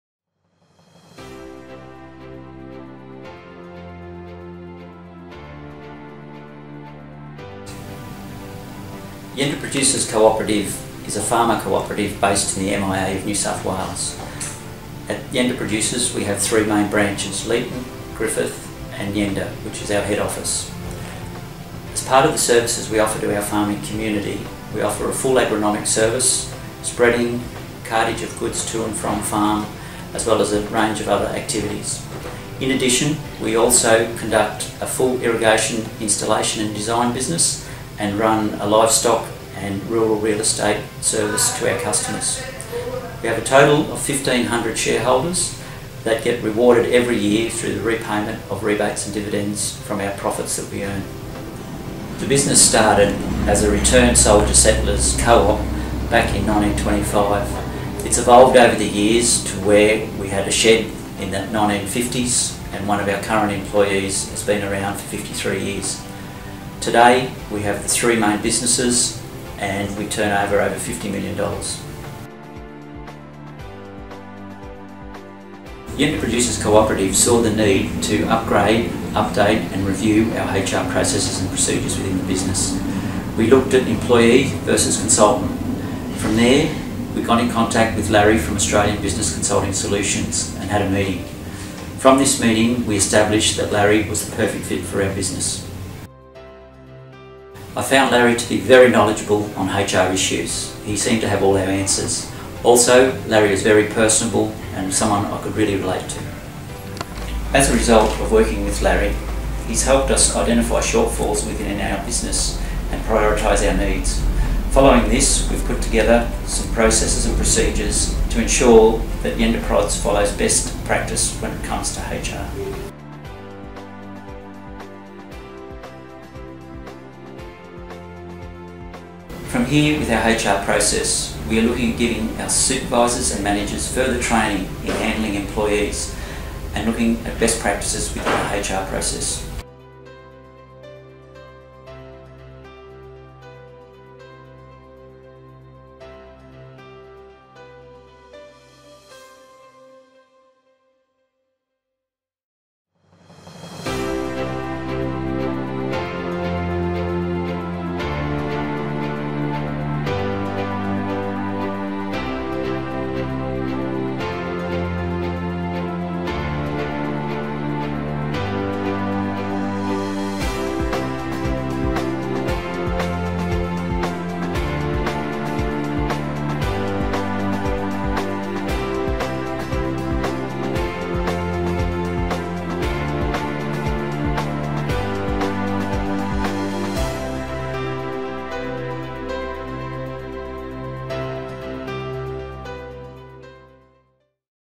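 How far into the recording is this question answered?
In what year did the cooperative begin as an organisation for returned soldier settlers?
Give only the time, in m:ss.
0:56.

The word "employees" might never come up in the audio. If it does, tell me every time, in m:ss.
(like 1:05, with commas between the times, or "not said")
1:03, 1:23, 2:15.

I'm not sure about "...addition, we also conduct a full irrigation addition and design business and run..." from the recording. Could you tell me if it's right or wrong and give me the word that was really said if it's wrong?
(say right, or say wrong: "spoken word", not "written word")
wrong: "installation", not "addition".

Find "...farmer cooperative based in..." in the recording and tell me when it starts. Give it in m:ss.
0:11.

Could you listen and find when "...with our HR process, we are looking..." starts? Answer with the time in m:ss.
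2:09.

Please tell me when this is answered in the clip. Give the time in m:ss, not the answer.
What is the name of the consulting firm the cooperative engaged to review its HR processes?
1:28.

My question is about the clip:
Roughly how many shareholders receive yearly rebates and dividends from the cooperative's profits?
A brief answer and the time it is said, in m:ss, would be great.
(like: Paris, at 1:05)
1,500, at 0:44.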